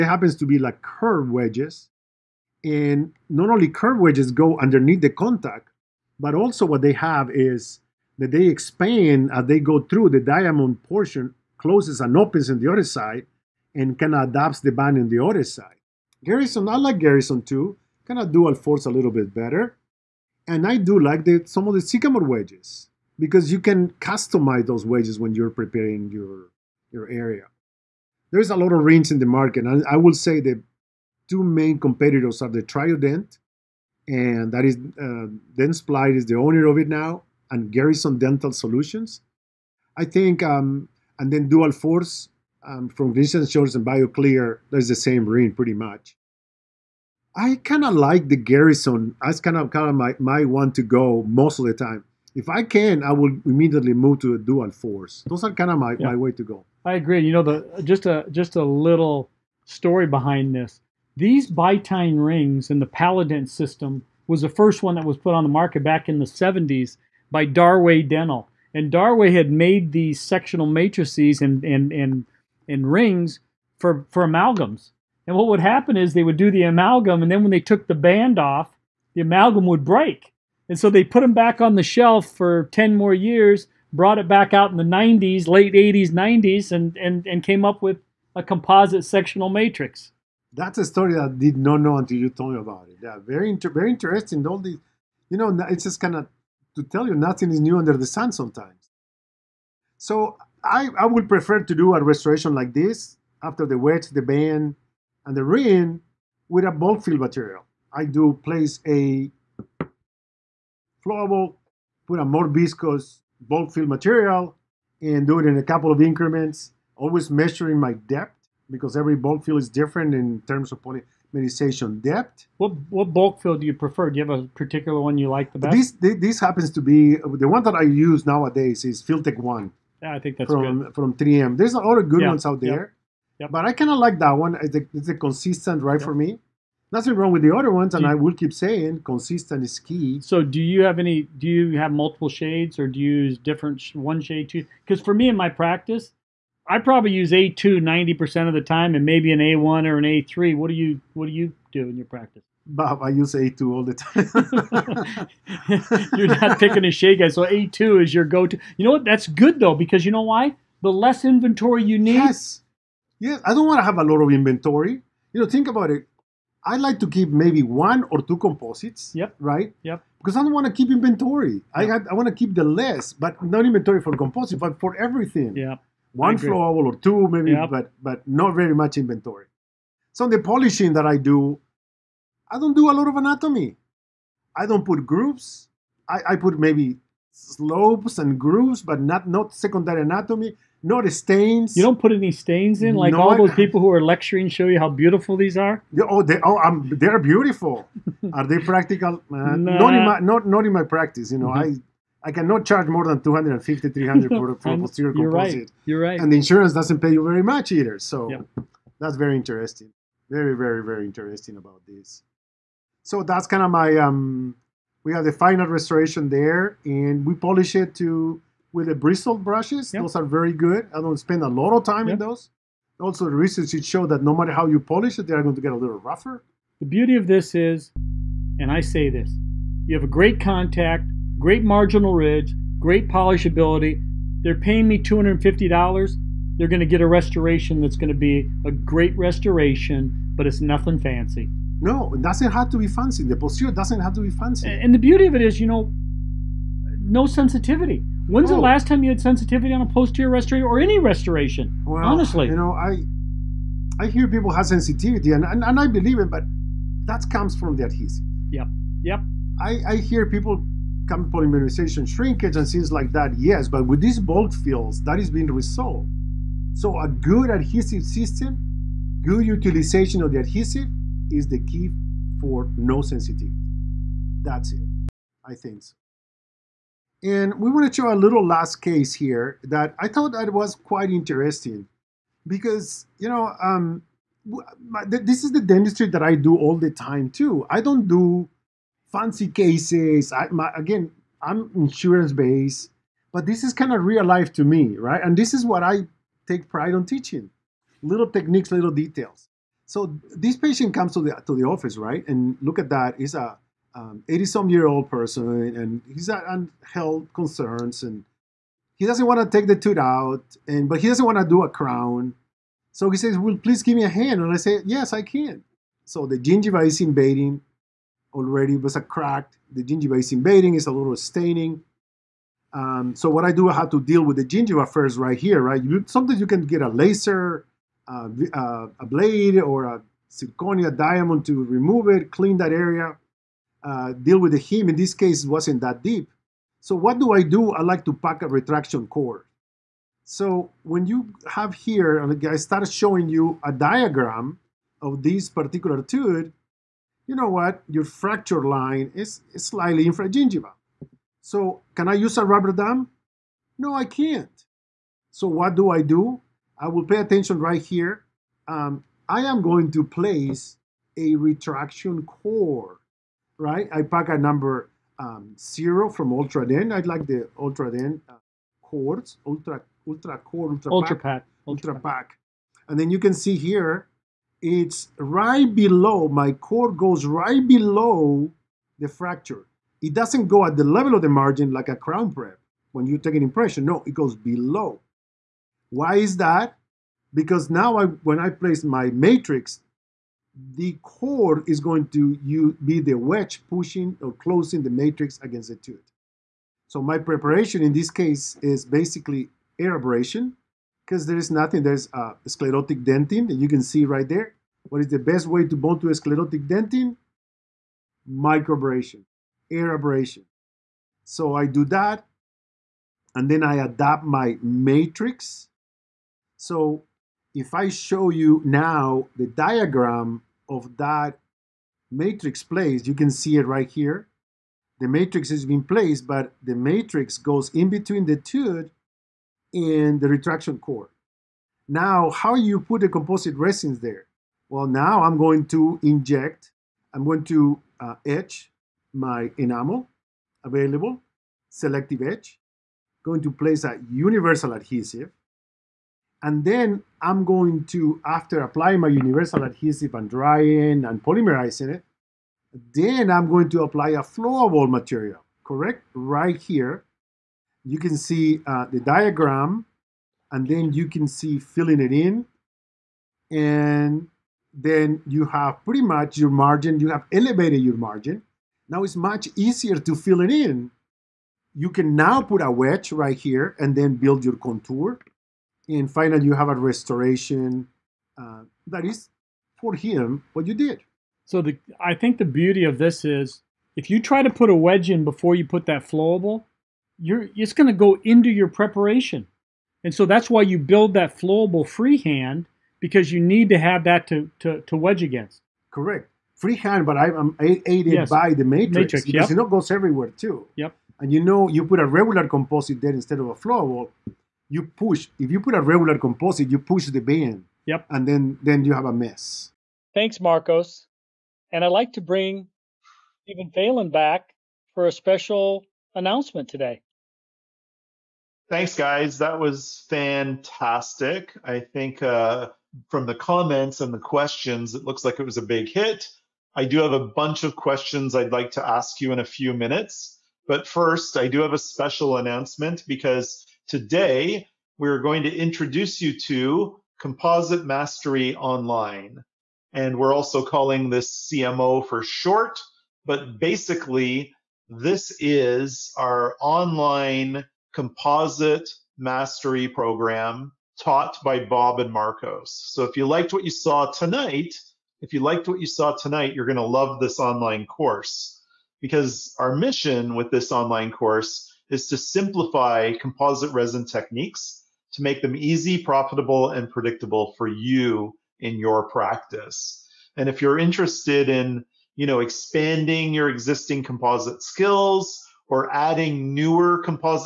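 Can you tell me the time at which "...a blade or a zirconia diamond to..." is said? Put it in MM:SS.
05:28.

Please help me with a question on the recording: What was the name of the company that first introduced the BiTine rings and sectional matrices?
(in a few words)
Darway Dental.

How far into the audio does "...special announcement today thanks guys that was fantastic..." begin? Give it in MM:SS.
08:35.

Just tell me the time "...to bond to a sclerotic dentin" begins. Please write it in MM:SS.
06:45.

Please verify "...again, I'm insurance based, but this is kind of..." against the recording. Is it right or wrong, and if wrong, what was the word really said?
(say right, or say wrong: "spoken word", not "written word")
right.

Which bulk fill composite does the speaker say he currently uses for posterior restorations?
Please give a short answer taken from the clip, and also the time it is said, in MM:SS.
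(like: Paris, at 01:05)
Filtek 1, at 02:09.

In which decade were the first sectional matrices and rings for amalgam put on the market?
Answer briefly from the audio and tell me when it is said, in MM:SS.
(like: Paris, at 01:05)
the 70s, at 01:06.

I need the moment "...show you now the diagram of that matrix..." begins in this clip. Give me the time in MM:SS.
06:57.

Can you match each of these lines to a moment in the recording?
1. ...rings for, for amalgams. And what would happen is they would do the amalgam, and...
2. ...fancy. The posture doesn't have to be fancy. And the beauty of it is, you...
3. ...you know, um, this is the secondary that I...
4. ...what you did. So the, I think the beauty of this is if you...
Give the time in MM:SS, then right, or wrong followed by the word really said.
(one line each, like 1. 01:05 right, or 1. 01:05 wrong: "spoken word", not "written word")
1. 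01:12 right
2. 04:02 right
3. 04:43 wrong: "dentistry", not "secondary"
4. 08:00 right.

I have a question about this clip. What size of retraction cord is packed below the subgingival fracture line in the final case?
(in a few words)
zero.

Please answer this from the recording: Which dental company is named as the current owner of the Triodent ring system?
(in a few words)
Dentsply.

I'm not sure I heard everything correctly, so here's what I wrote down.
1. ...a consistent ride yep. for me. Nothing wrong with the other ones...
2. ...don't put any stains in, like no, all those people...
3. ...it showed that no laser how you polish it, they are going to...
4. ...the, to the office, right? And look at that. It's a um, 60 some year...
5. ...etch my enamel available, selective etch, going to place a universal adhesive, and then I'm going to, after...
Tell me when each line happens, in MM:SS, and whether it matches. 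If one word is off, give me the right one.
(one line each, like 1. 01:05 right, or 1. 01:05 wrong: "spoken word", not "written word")
1. 02:15 right
2. 03:11 right
3. 03:43 wrong: "matter", not "laser"
4. 05:01 wrong: "80", not "60"
5. 07:18 right.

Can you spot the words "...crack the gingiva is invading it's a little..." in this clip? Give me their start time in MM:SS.
05:19.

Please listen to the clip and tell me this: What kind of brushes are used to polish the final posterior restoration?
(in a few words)
bristle brushes.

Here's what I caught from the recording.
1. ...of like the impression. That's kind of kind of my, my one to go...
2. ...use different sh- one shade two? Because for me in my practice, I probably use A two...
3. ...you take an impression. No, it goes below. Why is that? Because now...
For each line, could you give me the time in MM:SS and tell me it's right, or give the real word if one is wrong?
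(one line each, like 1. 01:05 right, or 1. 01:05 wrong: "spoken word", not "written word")
1. 00:47 wrong: "garrison", not "impression"
2. 02:23 right
3. 06:23 right.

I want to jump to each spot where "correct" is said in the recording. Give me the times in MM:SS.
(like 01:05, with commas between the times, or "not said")
07:35, 08:15.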